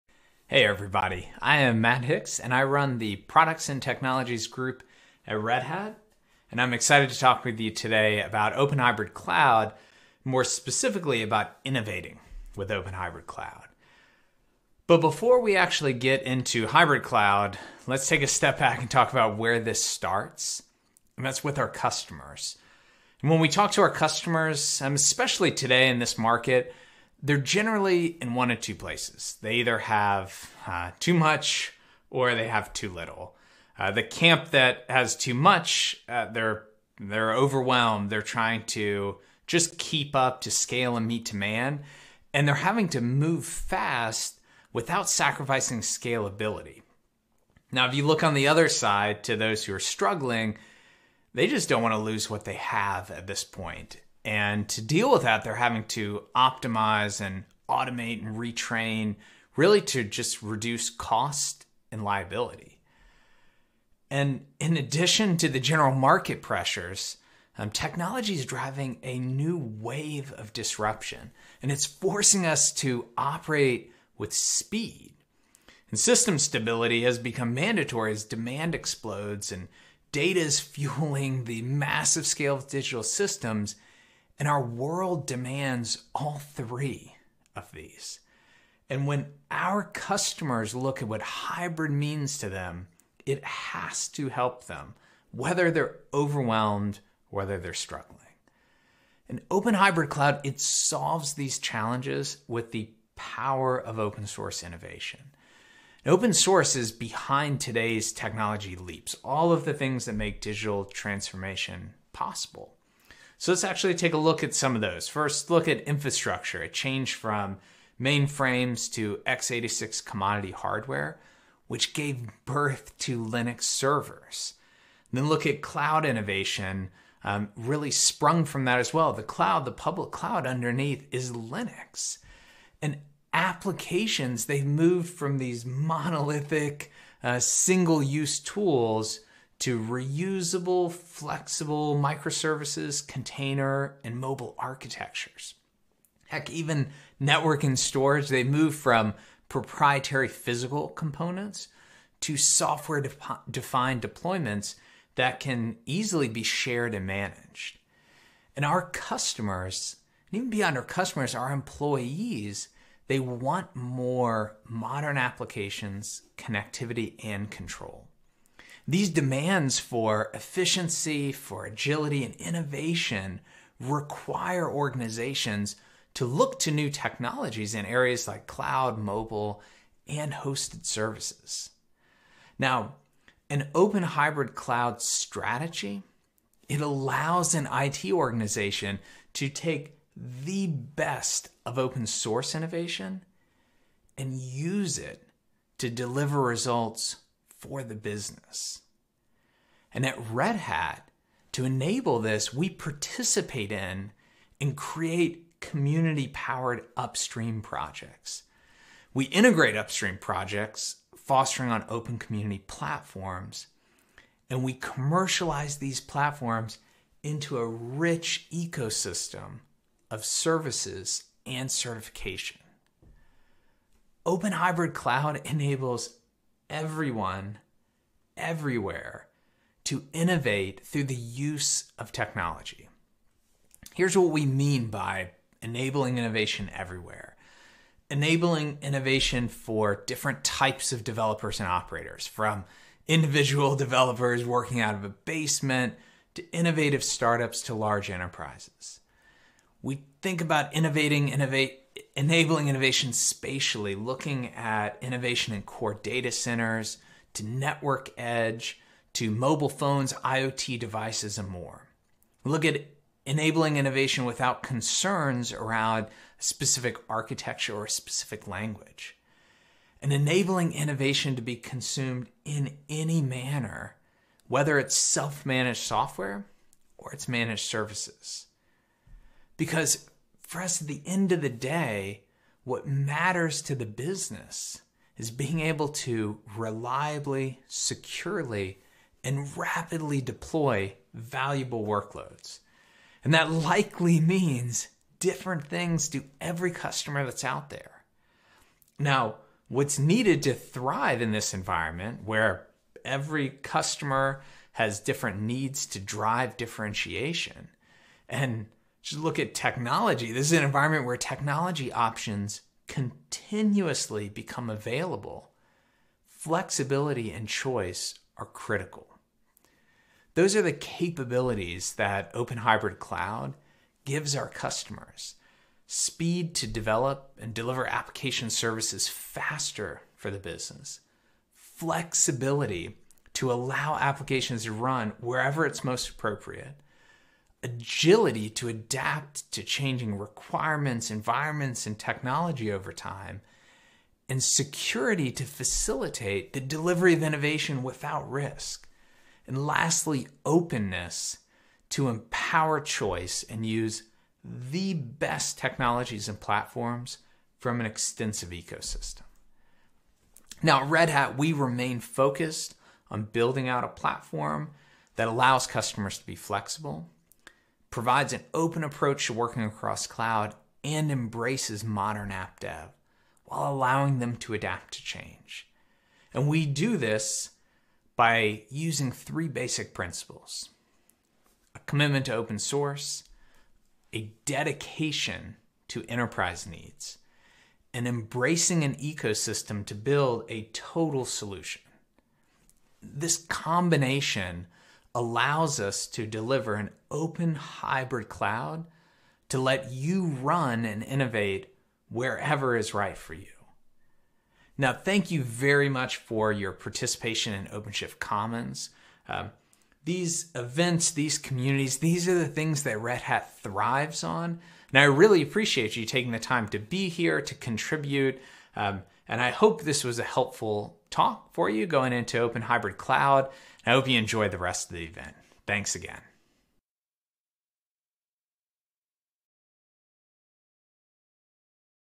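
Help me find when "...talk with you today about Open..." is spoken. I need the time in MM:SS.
00:07.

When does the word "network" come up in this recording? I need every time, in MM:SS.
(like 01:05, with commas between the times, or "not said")
02:27, 04:17.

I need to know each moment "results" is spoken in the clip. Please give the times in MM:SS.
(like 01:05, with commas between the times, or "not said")
03:16.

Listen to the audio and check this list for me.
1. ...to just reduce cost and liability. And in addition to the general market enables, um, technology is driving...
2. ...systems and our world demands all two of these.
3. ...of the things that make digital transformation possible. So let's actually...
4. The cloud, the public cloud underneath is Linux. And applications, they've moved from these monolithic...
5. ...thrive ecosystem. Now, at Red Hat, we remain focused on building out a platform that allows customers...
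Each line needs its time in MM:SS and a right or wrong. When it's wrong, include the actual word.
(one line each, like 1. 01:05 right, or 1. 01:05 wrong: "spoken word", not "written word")
1. 00:59 wrong: "pressures", not "enables"
2. 01:23 wrong: "three", not "two"
3. 01:49 right
4. 02:09 right
5. 05:57 wrong: "extensive", not "thrive".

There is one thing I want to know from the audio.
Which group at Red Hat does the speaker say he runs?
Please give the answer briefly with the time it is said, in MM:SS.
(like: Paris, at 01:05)
Products and Technologies, at 00:03.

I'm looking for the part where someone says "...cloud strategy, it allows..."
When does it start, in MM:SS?
03:04.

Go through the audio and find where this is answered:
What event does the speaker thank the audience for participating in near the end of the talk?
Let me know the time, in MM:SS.
06:47.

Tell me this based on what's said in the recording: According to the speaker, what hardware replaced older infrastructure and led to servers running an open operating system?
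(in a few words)
x86 commodity hardware.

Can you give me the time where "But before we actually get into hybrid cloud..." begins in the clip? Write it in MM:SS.
00:14.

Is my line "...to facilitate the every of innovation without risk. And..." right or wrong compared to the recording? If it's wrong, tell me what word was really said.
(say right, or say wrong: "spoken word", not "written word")
wrong: "delivery", not "every".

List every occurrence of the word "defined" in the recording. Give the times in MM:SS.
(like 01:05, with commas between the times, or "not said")
02:33.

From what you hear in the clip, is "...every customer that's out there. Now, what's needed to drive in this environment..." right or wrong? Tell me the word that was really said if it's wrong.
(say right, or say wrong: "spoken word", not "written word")
wrong: "thrive", not "drive".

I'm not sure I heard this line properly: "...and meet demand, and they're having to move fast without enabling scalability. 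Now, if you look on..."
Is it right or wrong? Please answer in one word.
wrong.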